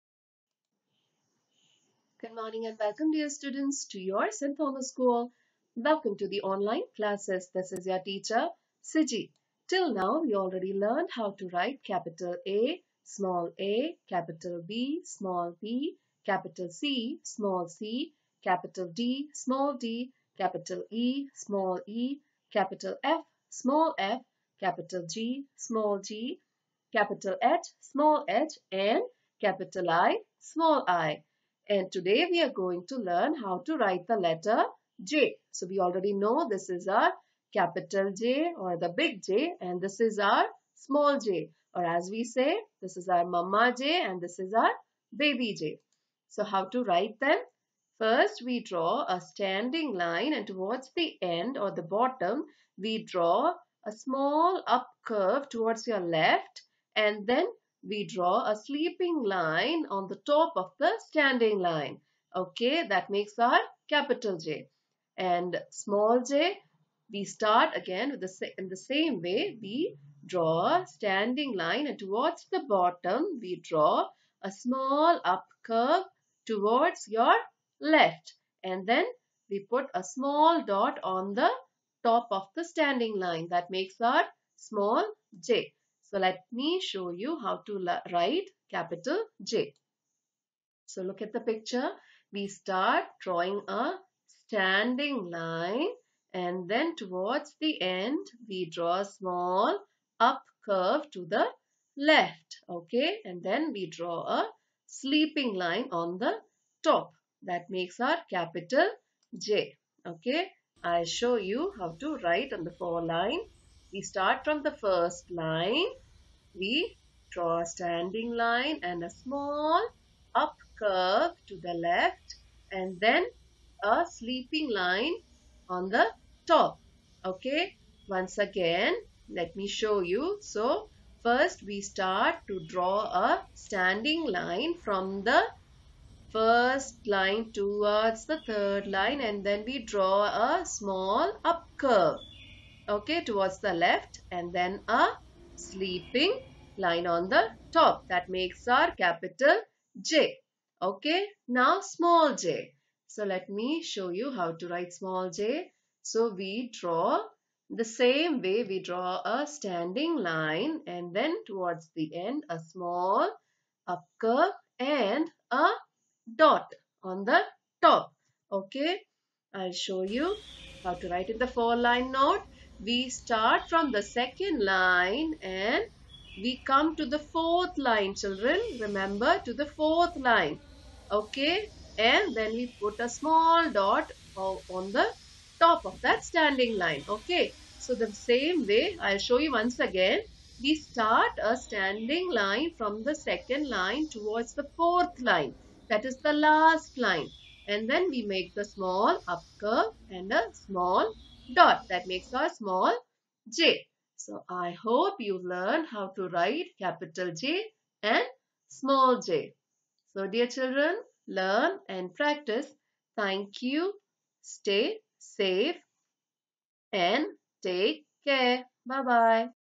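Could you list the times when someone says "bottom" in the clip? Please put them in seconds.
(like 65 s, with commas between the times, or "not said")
51 s, 72 s.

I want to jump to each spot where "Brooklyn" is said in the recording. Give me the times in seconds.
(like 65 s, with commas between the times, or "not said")
not said.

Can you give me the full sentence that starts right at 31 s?
And today we are going to learn how to write the letter J.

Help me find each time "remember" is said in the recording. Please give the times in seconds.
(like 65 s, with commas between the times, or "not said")
178 s.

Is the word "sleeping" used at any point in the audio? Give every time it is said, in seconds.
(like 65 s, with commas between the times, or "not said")
58 s, 104 s, 124 s, 145 s.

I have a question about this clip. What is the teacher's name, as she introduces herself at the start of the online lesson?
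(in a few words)
Siji.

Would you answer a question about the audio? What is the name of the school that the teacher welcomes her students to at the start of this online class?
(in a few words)
St. Thomas School.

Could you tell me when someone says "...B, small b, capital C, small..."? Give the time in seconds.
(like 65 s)
14 s.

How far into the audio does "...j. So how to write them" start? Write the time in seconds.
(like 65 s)
45 s.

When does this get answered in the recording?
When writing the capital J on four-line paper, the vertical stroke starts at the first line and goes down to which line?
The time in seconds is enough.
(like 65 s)
138 s.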